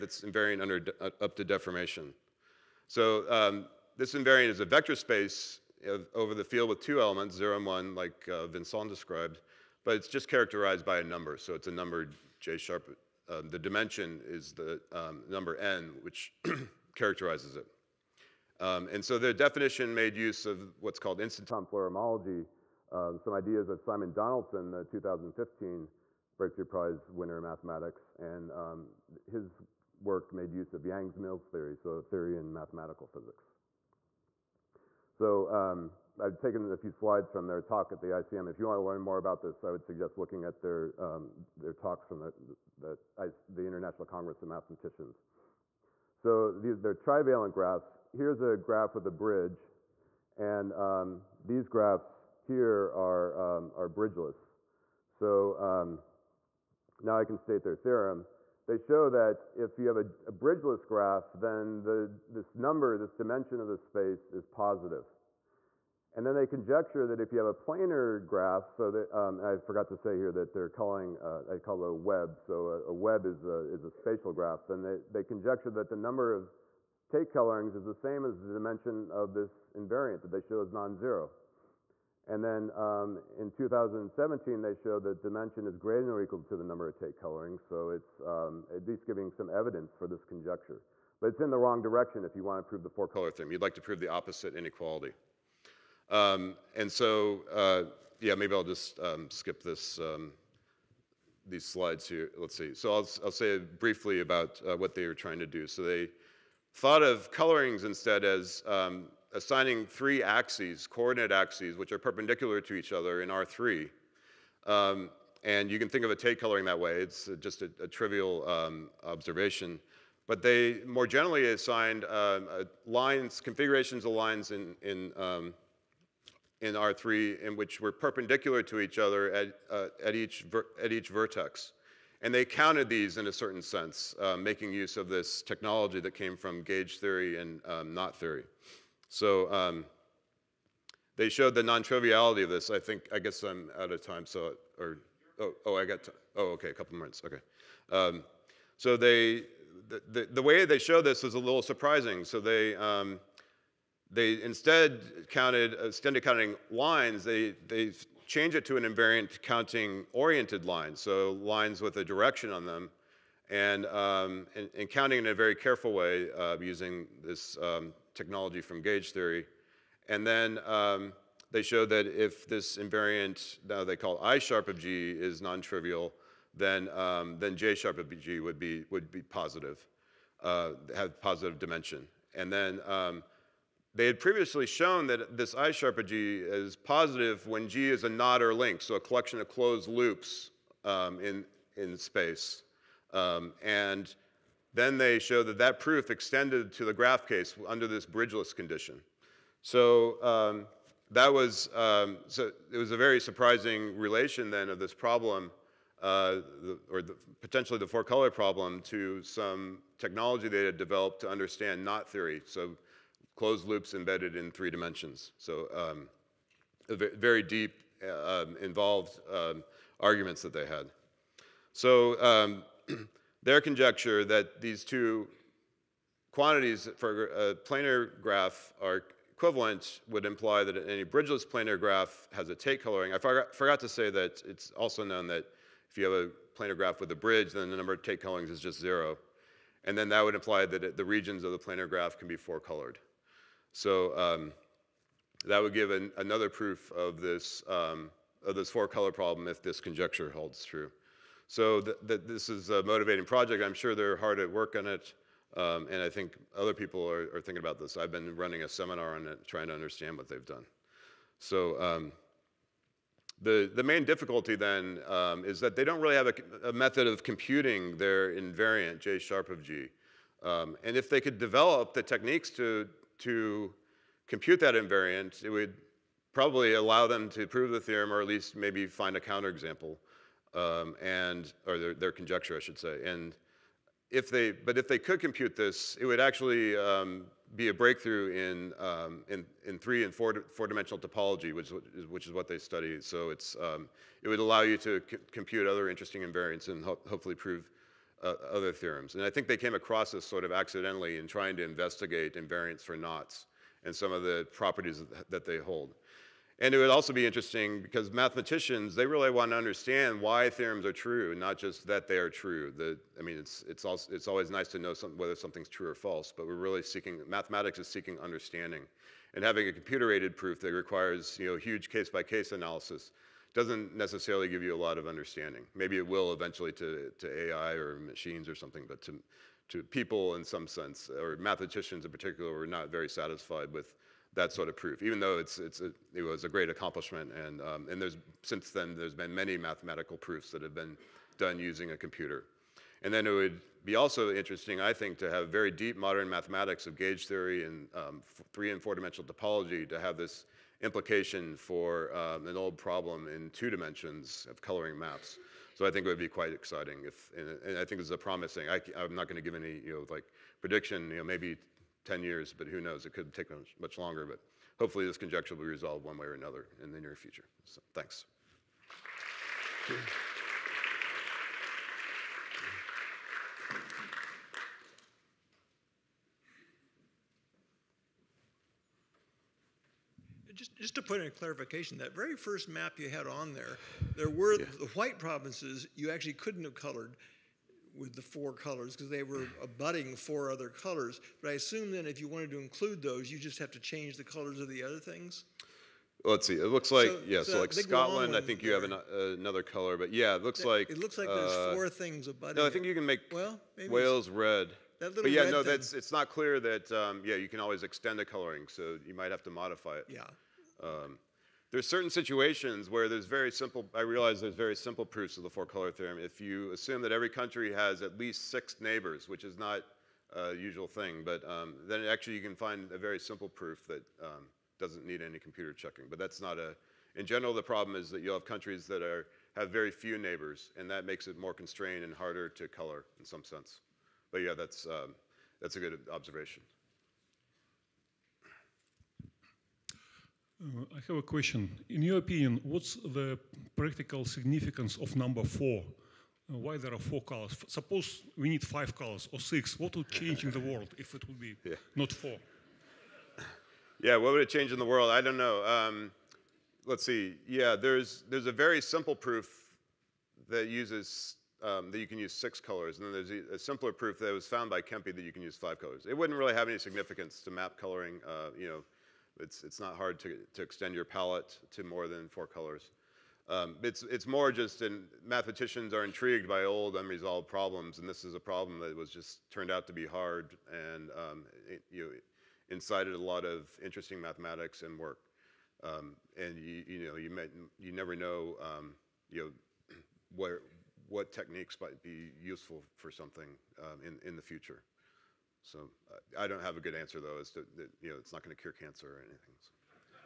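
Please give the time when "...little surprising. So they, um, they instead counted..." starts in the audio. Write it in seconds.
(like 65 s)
151 s.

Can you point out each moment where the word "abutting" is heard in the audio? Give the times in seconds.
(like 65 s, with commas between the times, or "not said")
389 s, 402 s.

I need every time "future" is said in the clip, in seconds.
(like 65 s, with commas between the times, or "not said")
367 s, 494 s.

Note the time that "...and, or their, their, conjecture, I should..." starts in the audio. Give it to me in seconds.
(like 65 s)
281 s.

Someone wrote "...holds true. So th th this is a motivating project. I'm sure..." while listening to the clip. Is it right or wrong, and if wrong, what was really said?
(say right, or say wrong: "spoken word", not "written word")
right.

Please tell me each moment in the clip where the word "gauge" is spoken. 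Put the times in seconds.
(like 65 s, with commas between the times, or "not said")
136 s, 168 s, 346 s.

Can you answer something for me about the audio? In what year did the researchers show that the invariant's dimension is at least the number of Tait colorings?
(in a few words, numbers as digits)
2017.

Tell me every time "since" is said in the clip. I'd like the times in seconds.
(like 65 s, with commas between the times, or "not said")
338 s.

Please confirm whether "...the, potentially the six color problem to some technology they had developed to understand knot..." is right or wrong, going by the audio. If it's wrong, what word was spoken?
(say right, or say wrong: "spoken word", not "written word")
wrong: "four", not "six".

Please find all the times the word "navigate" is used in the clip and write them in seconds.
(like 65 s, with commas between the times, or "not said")
not said.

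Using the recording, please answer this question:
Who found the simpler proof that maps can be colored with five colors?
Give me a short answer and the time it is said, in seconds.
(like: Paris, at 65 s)
Kempe, at 464 s.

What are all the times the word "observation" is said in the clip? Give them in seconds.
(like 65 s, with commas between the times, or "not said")
119 s, 436 s.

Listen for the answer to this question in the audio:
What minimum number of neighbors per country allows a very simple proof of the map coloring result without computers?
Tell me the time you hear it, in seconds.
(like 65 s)
418 s.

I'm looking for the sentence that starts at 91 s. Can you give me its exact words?
But it's in the wrong direction if you want to prove the four-color theorem.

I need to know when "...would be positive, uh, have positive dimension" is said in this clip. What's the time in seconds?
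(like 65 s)
178 s.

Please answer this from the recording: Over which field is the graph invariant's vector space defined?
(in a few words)
field with two elements.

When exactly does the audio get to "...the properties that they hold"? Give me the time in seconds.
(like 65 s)
304 s.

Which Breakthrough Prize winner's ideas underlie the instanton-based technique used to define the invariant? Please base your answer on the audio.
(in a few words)
Simon Donaldson.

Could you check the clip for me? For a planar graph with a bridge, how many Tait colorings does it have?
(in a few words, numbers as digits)
0.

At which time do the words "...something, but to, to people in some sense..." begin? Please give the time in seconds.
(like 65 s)
328 s.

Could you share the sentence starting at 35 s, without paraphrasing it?
So um, I've taken a few slides from their talk at the ICM.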